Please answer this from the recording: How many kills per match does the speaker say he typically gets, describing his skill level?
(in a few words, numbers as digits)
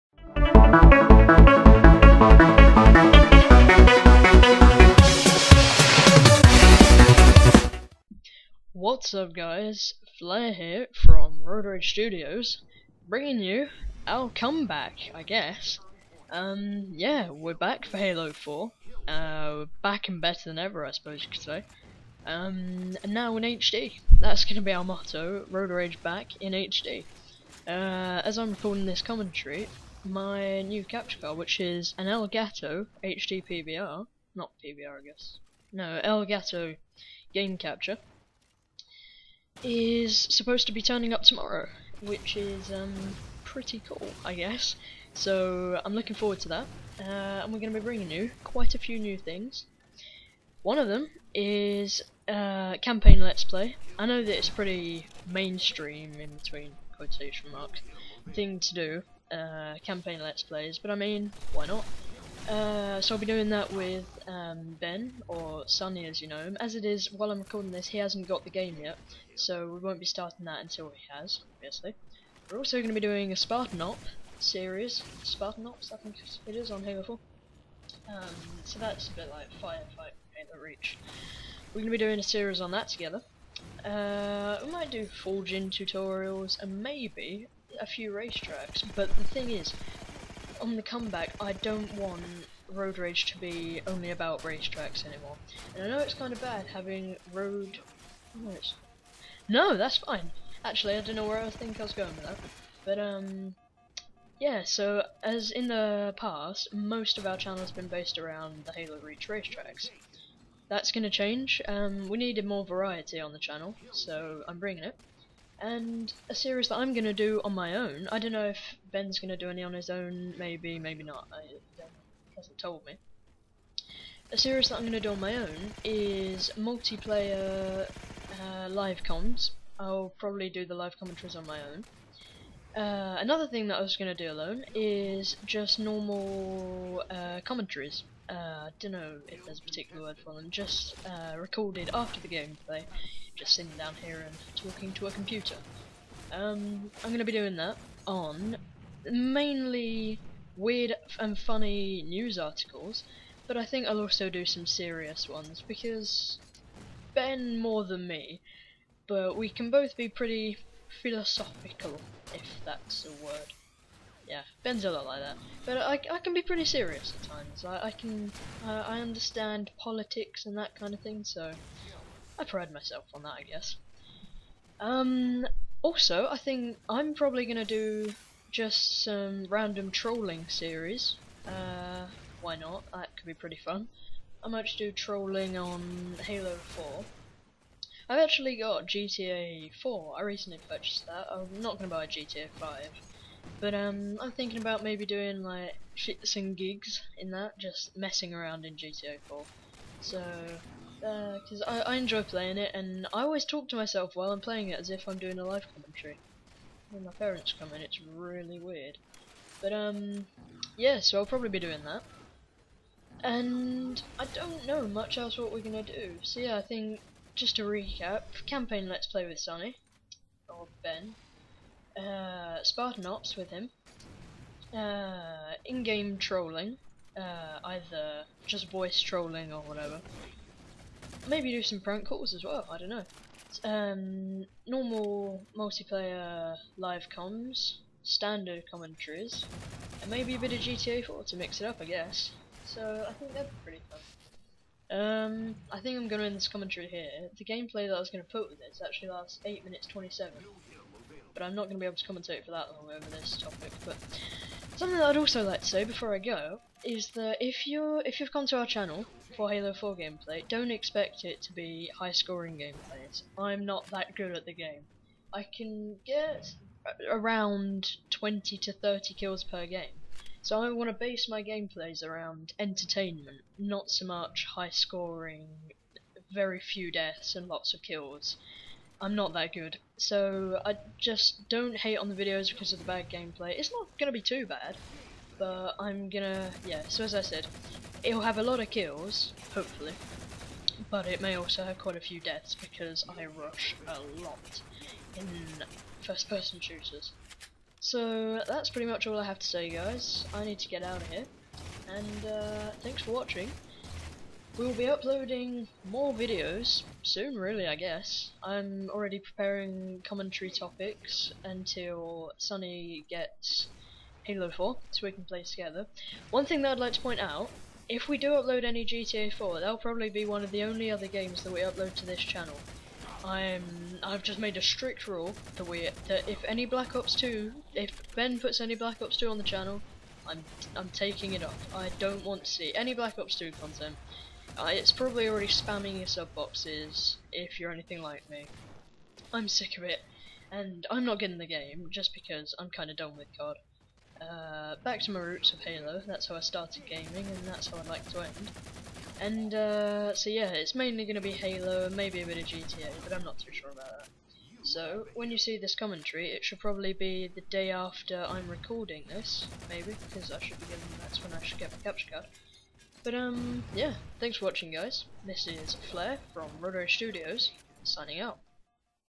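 20 to 30.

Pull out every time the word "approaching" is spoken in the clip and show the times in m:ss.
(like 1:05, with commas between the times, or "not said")
not said.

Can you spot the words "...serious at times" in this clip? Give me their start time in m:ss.
2:46.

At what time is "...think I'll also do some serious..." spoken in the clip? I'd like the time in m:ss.
2:33.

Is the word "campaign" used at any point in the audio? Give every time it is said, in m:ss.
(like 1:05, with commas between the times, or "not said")
0:52, 0:59, 3:38.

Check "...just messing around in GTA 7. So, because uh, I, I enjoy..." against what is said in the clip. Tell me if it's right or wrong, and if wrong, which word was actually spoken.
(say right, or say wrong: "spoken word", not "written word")
wrong: "4", not "7".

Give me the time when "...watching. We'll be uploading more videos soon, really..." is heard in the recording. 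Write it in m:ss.
5:03.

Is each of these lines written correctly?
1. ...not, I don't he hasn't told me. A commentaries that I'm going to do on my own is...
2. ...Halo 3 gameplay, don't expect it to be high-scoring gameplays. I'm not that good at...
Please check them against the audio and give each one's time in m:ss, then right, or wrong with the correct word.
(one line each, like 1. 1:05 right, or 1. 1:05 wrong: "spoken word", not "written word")
1. 2:01 wrong: "series", not "commentaries"
2. 4:19 wrong: "4", not "3".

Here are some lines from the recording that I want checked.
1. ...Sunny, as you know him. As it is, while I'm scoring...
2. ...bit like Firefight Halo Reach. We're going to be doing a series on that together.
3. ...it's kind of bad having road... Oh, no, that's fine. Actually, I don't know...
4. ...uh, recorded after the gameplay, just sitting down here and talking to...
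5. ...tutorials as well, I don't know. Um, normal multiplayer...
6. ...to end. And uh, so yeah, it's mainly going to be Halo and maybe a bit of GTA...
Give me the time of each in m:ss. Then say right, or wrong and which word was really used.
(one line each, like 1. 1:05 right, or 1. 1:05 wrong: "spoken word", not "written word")
1. 1:05 wrong: "recording", not "scoring"
2. 1:19 right
3. 1:36 right
4. 2:21 right
5. 3:52 wrong: "calls", not "tutorials"
6. 5:48 right.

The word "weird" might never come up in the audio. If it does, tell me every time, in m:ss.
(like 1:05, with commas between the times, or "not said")
2:30, 3:28.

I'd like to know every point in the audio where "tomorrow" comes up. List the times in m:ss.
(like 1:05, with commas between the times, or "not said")
0:41.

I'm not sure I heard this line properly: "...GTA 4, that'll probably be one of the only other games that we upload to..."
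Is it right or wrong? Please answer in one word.
right.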